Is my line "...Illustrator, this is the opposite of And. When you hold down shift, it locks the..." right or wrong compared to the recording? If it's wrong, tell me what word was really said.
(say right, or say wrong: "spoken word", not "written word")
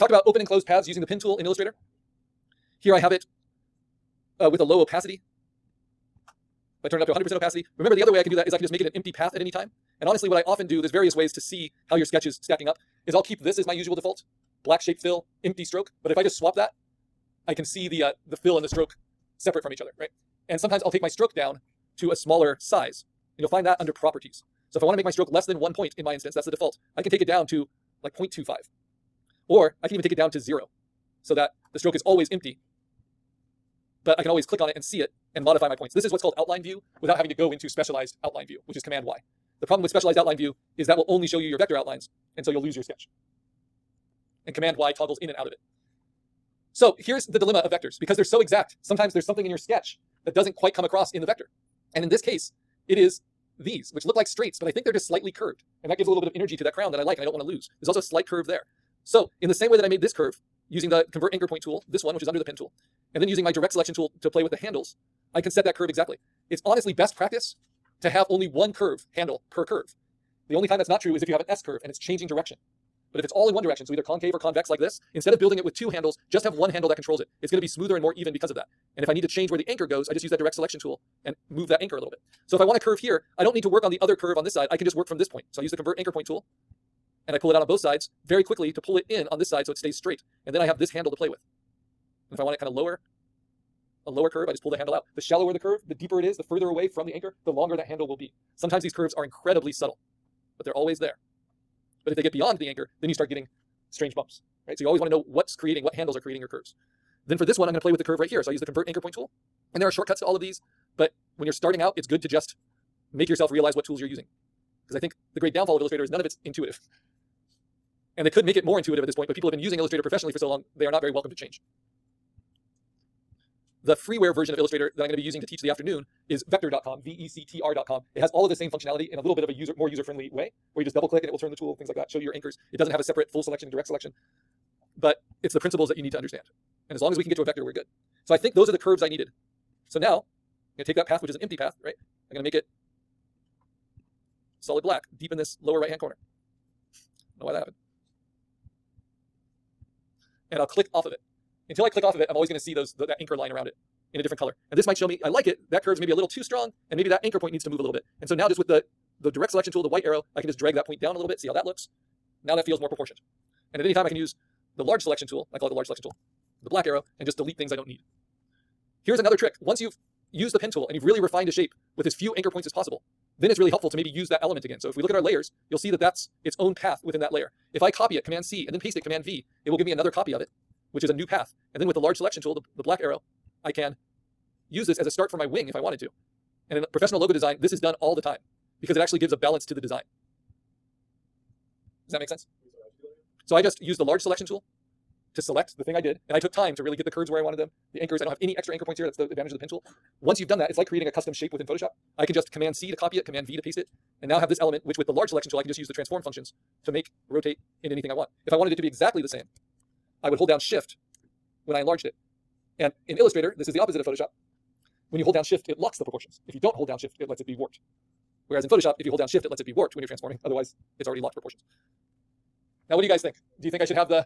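wrong: "Photoshop", not "And".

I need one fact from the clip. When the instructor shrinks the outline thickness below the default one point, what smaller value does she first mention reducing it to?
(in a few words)
0.25.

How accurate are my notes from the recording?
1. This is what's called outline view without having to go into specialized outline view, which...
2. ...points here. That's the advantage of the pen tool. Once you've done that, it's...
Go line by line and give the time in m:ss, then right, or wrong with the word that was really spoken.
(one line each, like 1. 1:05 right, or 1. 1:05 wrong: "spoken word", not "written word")
1. 0:35 right
2. 3:18 right.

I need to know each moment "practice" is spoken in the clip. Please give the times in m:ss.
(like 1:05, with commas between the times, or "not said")
1:07.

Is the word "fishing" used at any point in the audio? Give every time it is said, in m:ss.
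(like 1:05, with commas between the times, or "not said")
not said.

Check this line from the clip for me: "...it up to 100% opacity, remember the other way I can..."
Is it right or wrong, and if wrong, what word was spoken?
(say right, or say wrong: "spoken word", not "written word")
right.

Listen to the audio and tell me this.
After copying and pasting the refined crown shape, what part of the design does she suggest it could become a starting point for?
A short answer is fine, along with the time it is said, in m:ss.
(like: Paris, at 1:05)
wing, at 3:05.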